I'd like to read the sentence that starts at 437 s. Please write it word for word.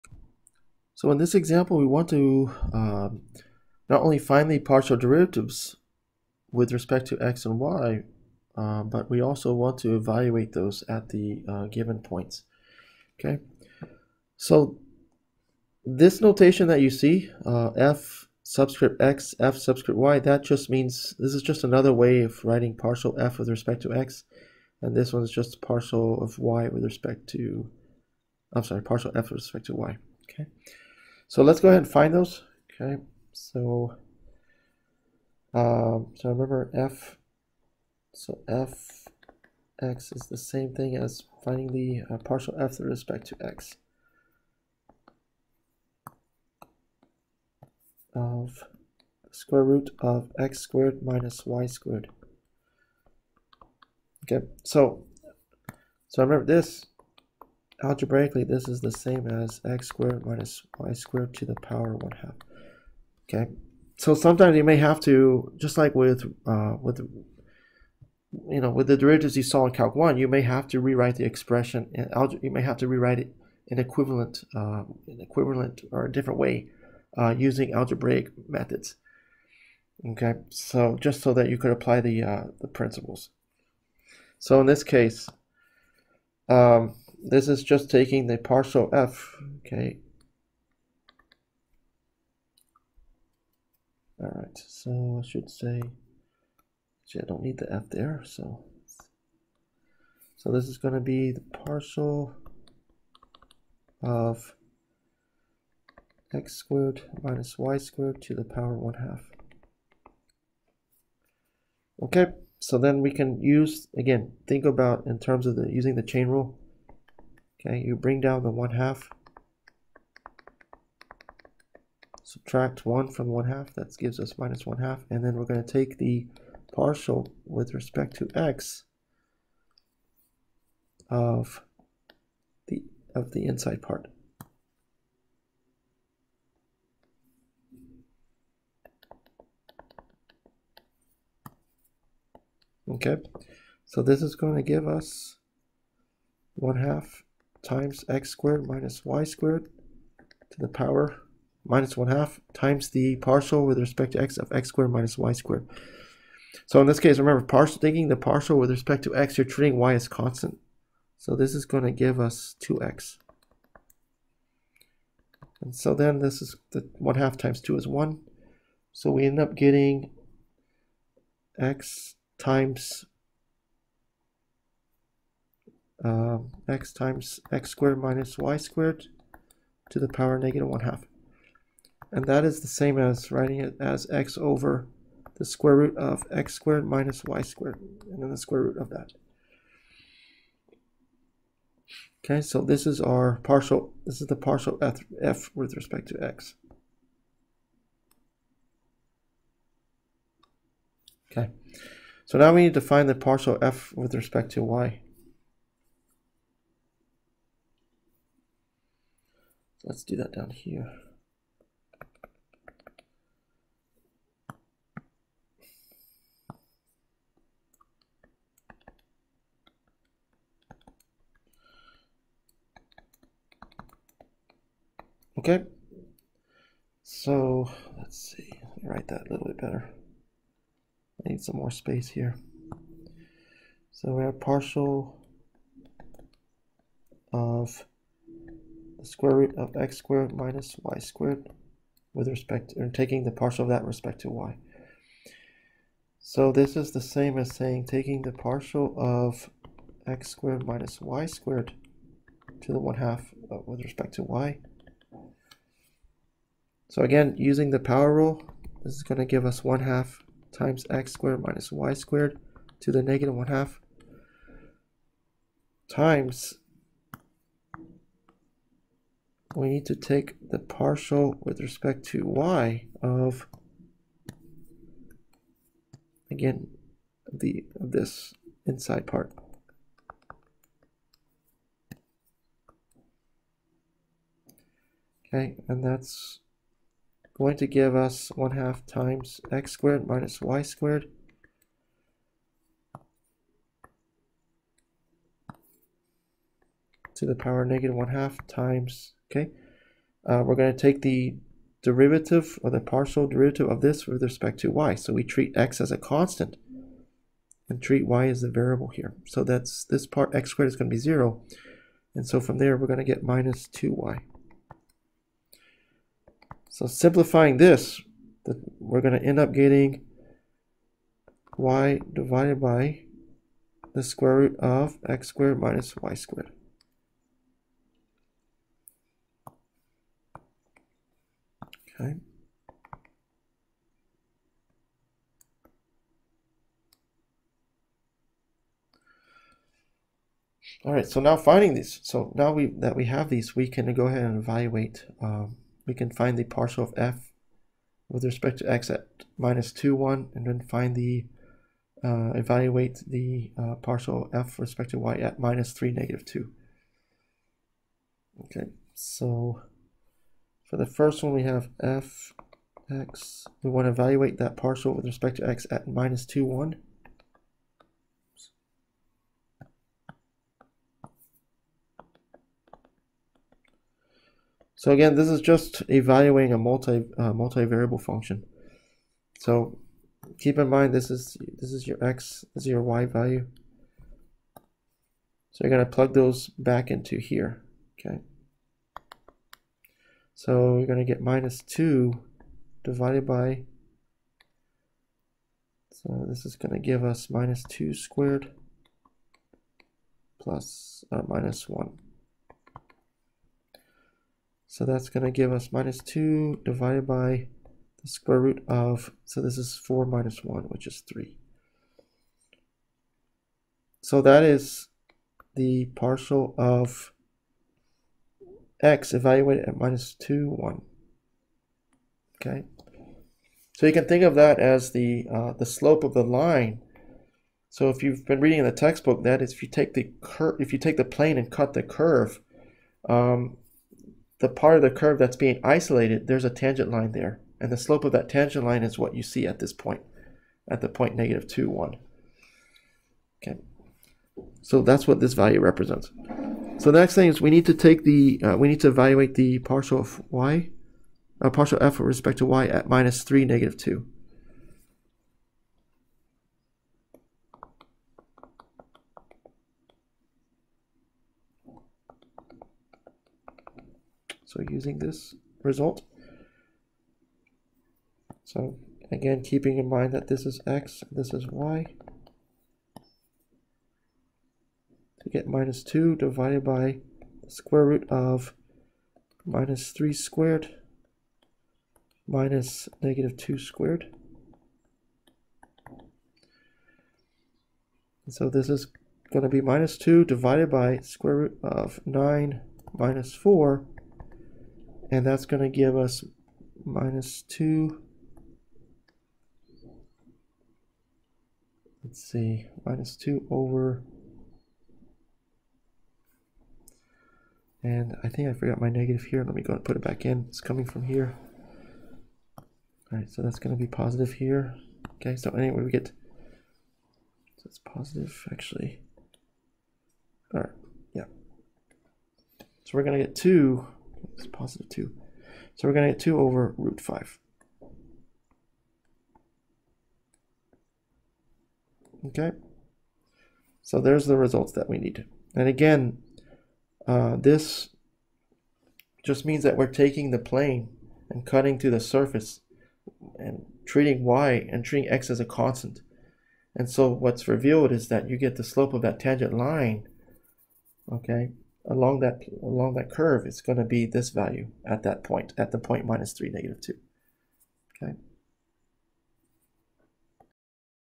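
And the slope of that tangent line is what you see at this point, at the point negative 2, 1.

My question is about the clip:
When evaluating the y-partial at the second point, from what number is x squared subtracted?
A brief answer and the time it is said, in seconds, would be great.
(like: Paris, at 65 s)
9, at 492 s.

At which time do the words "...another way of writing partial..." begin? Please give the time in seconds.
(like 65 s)
21 s.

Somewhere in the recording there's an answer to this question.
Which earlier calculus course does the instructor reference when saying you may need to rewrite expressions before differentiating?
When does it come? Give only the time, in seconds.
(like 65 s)
69 s.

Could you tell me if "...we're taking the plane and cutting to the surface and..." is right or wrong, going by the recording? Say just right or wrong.
right.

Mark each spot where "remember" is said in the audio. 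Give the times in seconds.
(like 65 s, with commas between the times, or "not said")
36 s, 56 s, 157 s.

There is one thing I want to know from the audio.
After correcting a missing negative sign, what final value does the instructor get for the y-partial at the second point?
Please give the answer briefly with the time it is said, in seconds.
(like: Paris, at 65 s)
2 over root 5, at 526 s.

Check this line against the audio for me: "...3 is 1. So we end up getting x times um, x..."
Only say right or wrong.
wrong.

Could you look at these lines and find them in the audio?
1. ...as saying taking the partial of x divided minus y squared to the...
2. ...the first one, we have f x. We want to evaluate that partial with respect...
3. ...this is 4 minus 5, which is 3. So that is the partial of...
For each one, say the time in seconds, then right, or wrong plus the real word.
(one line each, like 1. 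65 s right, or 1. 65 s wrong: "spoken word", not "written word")
1. 247 s wrong: "squared", not "divided"
2. 360 s right
3. 409 s wrong: "1", not "5".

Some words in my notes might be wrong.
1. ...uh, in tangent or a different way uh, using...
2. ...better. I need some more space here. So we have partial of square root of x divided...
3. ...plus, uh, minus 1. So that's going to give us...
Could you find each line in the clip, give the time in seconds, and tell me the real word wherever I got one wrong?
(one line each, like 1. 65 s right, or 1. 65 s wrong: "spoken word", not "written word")
1. 74 s wrong: "equivalent", not "tangent"
2. 229 s wrong: "squared", not "divided"
3. 400 s right.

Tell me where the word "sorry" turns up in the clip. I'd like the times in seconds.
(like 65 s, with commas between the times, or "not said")
28 s.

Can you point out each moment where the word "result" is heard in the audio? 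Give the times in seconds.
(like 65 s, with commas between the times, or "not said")
465 s, 534 s.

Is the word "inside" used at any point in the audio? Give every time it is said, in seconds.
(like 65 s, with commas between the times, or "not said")
133 s, 278 s.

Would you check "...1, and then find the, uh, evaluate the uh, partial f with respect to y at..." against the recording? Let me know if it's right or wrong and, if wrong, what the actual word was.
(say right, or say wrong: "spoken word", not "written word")
right.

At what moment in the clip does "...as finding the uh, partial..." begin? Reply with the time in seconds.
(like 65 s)
40 s.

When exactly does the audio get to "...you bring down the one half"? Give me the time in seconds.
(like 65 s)
117 s.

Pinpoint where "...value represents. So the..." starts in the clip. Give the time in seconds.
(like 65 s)
445 s.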